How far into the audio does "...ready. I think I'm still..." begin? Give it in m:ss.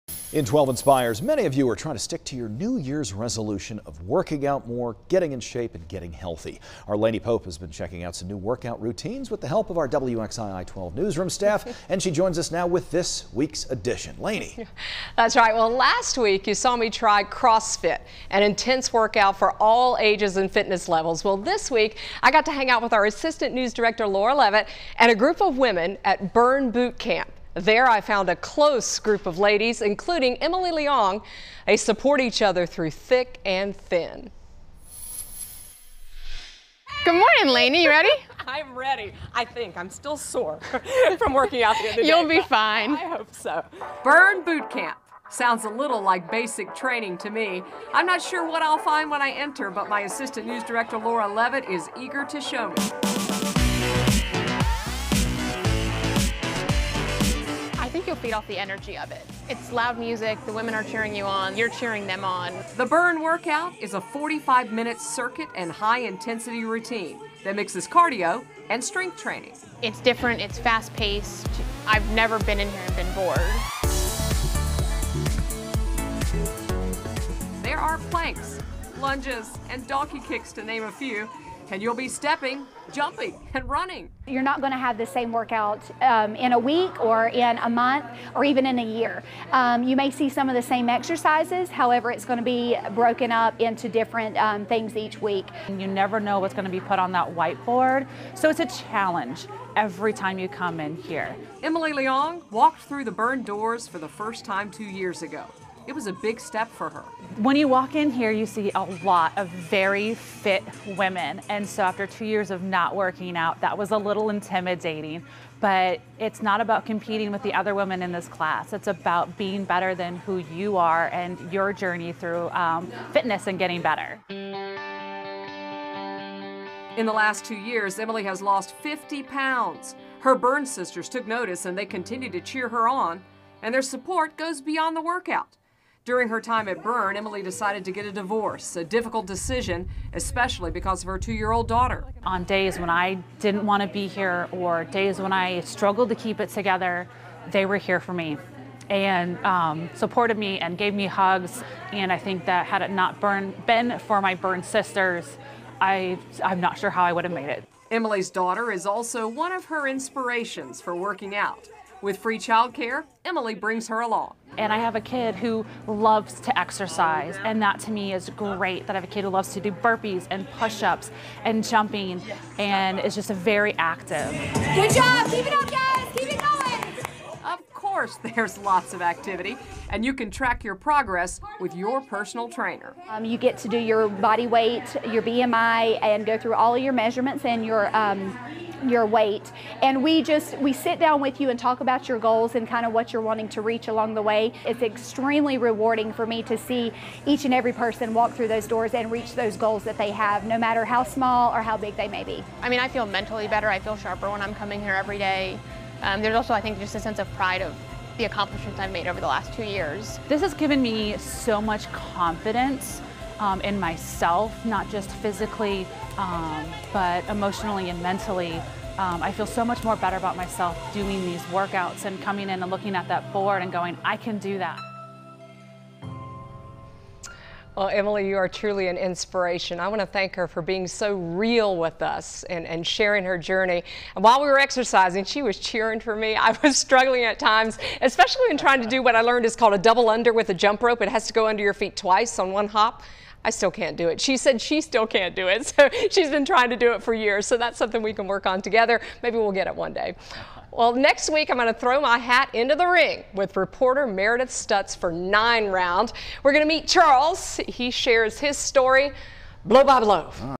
0:38.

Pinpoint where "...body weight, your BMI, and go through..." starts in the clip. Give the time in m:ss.
3:04.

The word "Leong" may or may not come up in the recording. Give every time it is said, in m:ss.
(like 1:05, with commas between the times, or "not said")
0:30, 1:41.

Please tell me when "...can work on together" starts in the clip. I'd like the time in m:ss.
4:08.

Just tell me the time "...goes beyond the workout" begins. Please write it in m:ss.
2:14.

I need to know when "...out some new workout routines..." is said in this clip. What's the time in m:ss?
0:08.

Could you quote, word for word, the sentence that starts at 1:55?
But it's not about competing with the other women in this class.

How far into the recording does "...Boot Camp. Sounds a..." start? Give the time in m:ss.
0:44.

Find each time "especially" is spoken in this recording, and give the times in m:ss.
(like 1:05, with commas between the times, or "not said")
2:20, 3:58.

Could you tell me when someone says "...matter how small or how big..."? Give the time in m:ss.
3:20.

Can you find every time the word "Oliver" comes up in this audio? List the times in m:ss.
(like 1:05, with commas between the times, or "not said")
not said.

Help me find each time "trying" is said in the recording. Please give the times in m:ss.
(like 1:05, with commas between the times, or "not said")
0:01, 3:58, 4:06.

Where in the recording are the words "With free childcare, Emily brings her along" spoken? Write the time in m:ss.
2:42.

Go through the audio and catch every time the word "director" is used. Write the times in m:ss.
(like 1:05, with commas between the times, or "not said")
0:23, 0:50.